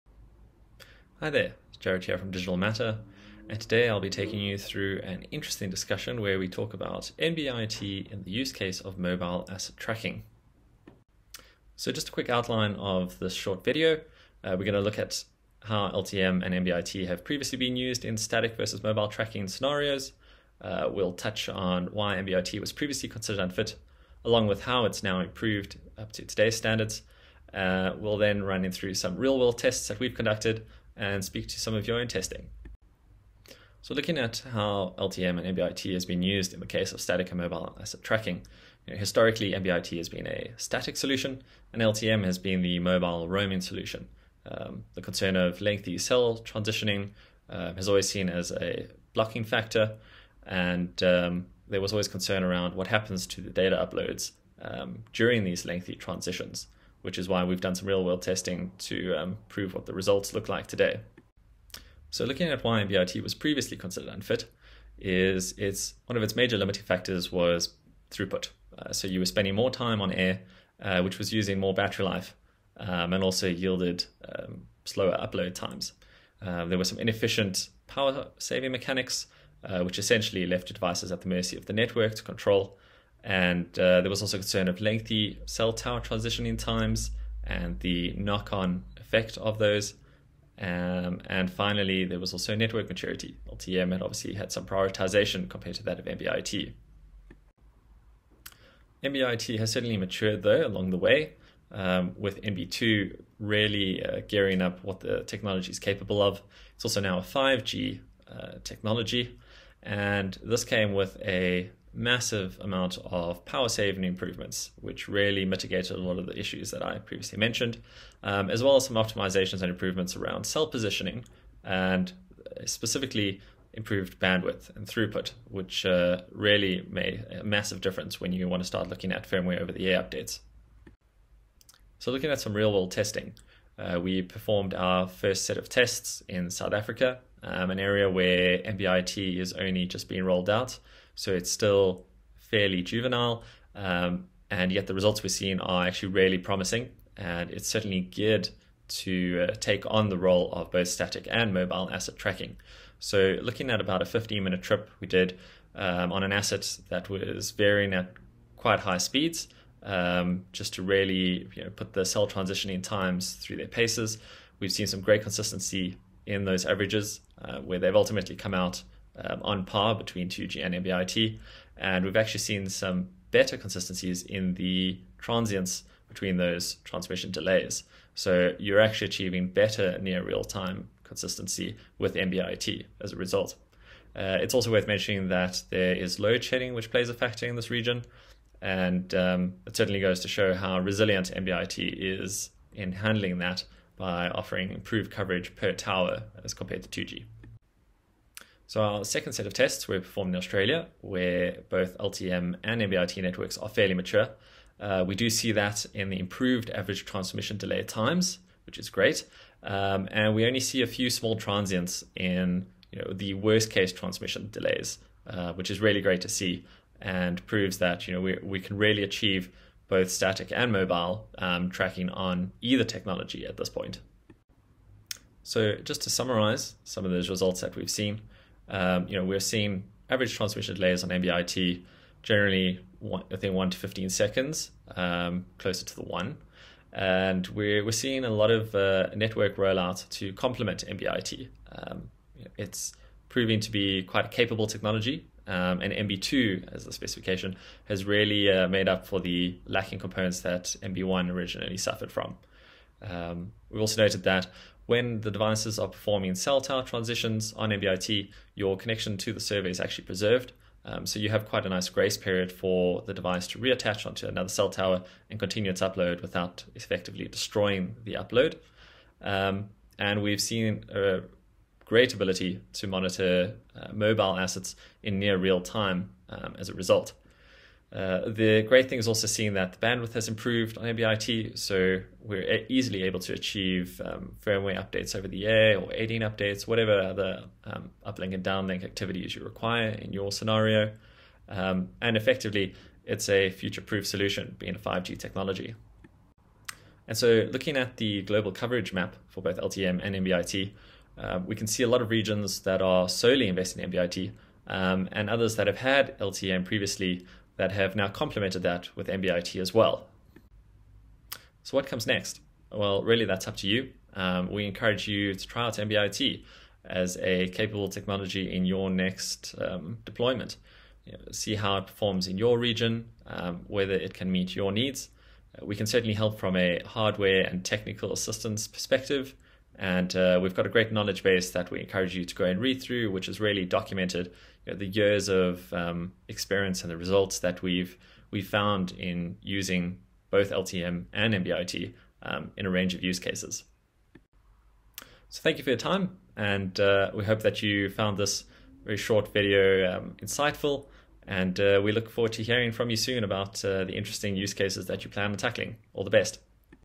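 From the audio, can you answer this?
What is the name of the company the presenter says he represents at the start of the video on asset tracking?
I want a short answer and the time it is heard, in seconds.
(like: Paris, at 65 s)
Digital Matter, at 2 s.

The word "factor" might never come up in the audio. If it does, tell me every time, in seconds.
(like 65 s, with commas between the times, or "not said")
49 s, 66 s, 187 s.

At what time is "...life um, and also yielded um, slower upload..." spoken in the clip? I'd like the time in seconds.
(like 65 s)
72 s.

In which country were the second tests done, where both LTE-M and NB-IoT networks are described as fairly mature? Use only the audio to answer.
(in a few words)
Australia.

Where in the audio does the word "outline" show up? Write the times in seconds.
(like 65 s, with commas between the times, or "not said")
12 s.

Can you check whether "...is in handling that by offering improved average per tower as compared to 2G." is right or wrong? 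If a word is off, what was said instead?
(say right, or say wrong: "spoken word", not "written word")
wrong: "coverage", not "average".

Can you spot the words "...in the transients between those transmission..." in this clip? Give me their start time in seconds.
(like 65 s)
174 s.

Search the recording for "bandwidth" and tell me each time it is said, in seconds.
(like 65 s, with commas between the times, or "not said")
124 s, 279 s.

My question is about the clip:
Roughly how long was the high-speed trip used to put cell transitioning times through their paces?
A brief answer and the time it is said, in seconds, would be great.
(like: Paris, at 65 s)
15 minutes, at 154 s.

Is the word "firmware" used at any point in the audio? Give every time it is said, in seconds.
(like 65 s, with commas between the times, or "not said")
129 s, 284 s.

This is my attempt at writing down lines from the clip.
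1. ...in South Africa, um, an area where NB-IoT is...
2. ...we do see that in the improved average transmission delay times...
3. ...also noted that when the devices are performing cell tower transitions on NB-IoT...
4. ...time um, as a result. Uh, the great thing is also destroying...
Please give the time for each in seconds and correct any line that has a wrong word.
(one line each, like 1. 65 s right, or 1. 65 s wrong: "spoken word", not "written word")
1. 136 s right
2. 205 s right
3. 253 s right
4. 275 s wrong: "seeing", not "destroying".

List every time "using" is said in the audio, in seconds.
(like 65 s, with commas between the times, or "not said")
71 s, 339 s.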